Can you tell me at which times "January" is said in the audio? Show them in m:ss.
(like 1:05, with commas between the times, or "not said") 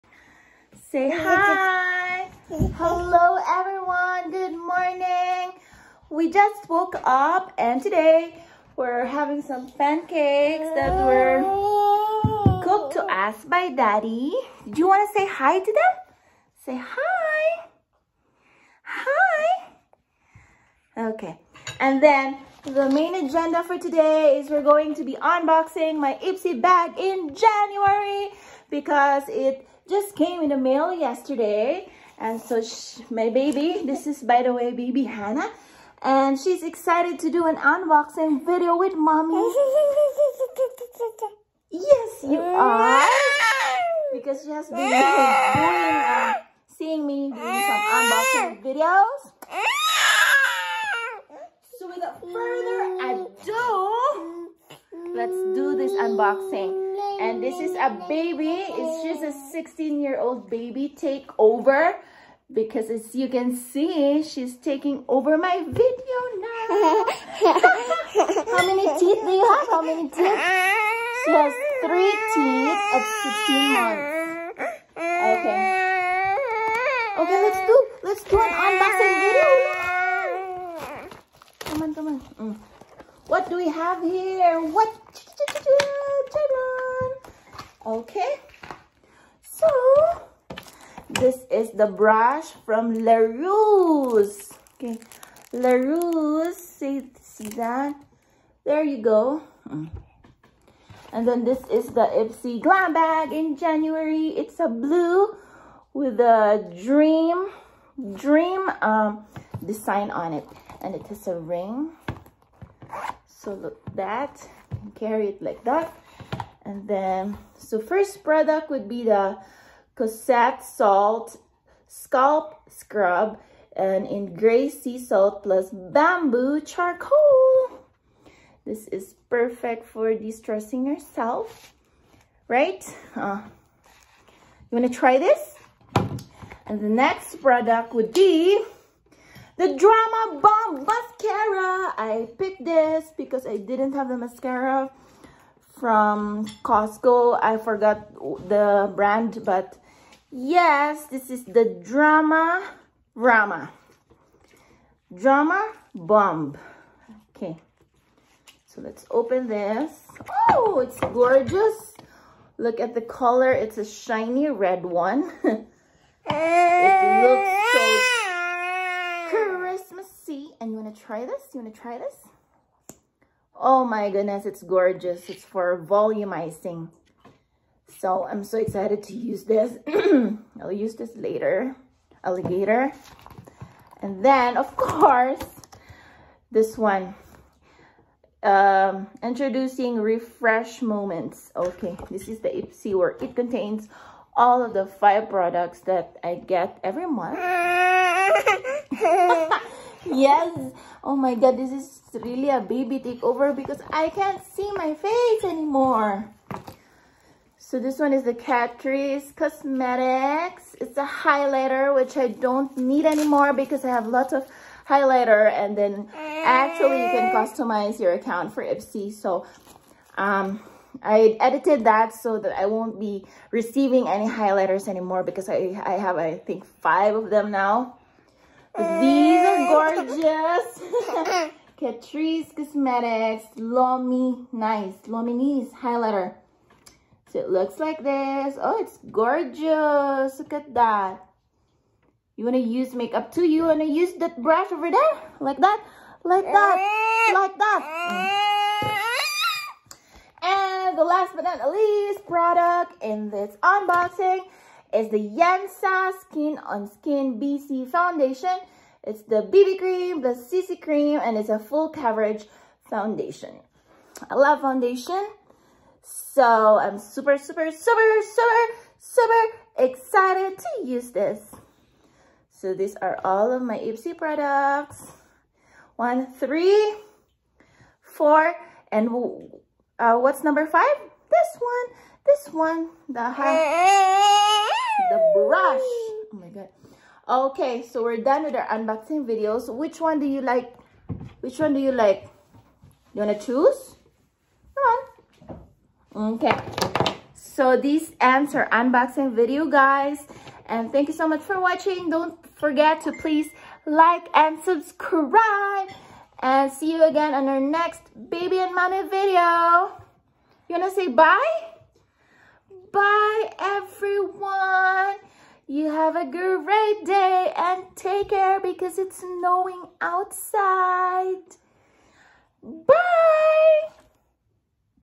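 0:27, 1:43.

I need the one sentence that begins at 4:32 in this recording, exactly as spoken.
So these are all of my Ipsy products.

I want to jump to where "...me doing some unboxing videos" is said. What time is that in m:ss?
0:47.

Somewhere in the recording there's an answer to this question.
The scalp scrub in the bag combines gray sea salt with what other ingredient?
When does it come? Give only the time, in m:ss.
2:05.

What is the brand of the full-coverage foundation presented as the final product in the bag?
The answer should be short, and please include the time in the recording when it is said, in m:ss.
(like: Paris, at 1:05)
Yensa, at 4:15.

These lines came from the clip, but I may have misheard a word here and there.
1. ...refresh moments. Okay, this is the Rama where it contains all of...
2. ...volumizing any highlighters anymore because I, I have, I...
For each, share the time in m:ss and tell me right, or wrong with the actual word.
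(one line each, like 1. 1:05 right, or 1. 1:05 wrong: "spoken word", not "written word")
1. 3:09 wrong: "Ipsy", not "Rama"
2. 3:43 wrong: "receiving", not "volumizing".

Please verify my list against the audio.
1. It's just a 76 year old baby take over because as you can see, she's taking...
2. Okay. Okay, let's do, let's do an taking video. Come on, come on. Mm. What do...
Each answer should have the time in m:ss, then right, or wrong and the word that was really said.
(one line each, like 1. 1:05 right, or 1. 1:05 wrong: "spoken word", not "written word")
1. 0:58 wrong: "16", not "76"
2. 1:14 wrong: "unboxing", not "taking".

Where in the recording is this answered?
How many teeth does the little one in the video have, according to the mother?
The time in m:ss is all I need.
1:11.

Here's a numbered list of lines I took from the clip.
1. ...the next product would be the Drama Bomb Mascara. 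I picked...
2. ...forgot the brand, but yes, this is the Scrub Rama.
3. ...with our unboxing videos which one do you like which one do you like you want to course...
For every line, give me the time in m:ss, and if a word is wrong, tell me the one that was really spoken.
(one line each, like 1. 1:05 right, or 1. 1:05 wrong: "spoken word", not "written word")
1. 2:16 right
2. 2:27 wrong: "Drama", not "Scrub"
3. 4:48 wrong: "choose", not "course".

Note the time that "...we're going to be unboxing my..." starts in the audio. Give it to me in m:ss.
0:24.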